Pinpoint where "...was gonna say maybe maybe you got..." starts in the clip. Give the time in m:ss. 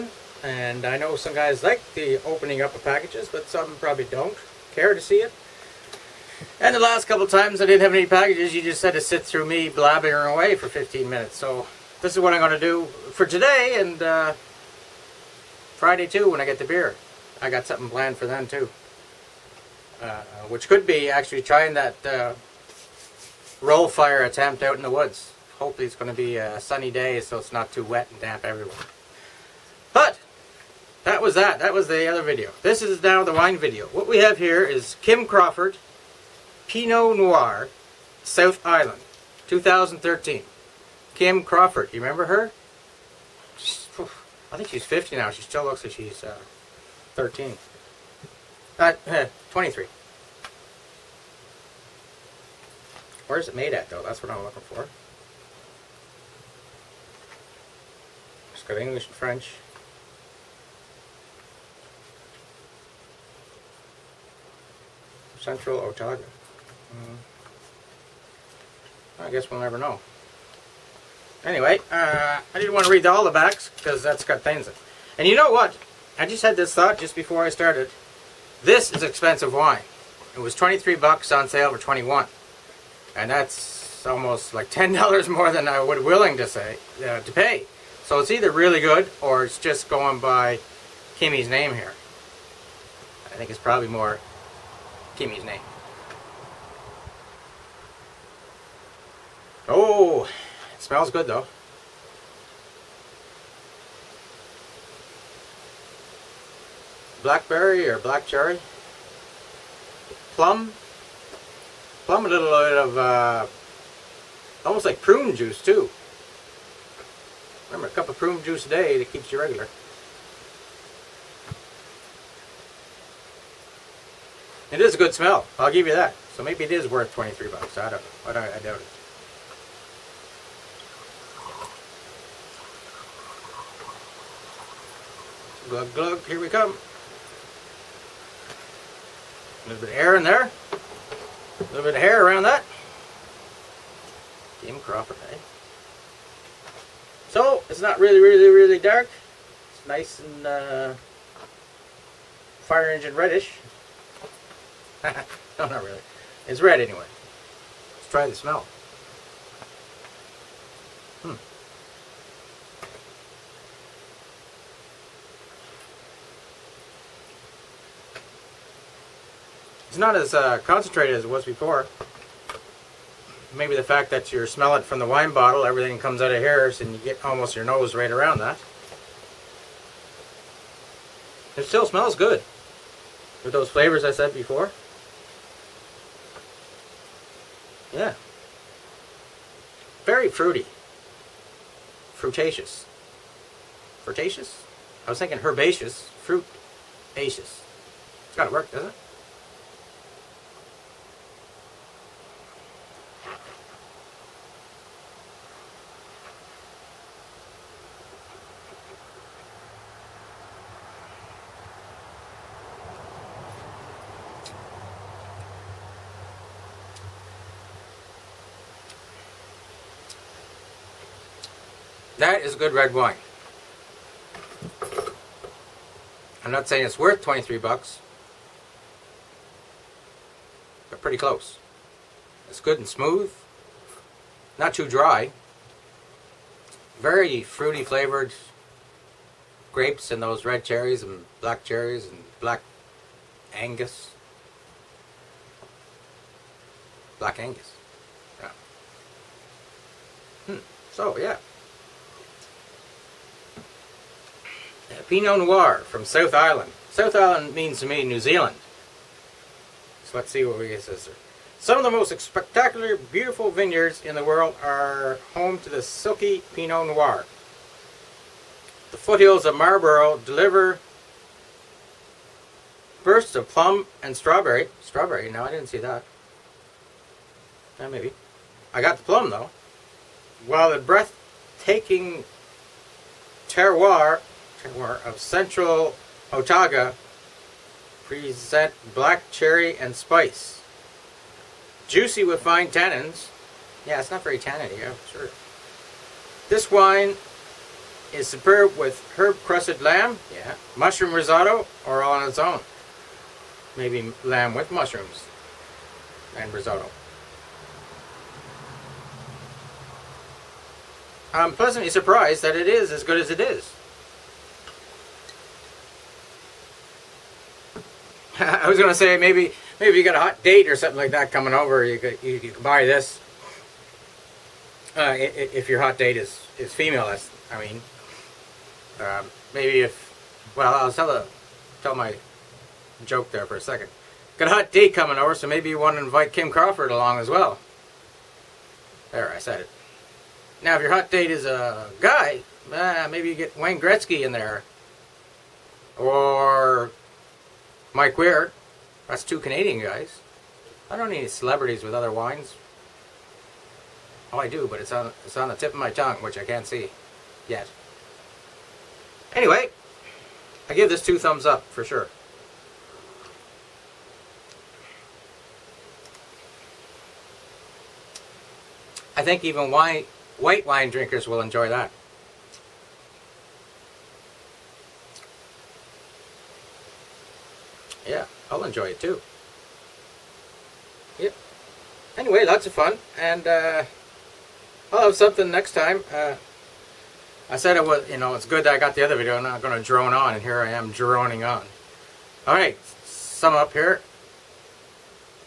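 5:18.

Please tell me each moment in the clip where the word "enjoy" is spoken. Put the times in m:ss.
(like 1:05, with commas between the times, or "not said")
6:11, 6:18.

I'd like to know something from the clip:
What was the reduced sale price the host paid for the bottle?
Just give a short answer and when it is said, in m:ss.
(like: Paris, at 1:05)
$21, at 1:21.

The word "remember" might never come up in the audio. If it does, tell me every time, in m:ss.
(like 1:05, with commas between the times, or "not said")
0:42, 1:57.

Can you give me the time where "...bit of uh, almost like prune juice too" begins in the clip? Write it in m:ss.
1:52.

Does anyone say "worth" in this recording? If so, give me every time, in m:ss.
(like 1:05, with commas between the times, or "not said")
2:06, 3:46.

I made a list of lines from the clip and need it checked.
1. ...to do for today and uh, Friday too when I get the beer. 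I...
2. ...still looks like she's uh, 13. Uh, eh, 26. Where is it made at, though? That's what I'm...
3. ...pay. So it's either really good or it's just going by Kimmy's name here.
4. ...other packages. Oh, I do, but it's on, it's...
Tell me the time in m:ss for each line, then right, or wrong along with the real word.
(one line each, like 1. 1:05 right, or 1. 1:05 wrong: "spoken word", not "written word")
1. 0:12 right
2. 0:45 wrong: "23", not "26"
3. 1:27 right
4. 5:51 wrong: "wines", not "packages".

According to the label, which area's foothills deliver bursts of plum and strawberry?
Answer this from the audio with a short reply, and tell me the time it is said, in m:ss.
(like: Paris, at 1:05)
Marlborough, at 4:29.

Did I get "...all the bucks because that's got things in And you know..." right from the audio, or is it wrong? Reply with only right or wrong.
wrong.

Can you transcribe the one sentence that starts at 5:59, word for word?
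Anyway, I give this two thumbs up for sure.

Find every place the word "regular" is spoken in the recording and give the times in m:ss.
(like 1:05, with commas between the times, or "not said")
1:59.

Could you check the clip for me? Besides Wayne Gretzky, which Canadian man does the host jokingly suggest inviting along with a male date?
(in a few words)
Mike Weir.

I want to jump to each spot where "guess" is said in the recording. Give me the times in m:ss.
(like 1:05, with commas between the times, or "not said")
1:09.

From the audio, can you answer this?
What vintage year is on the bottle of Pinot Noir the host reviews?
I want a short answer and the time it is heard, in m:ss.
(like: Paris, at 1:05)
2013, at 0:39.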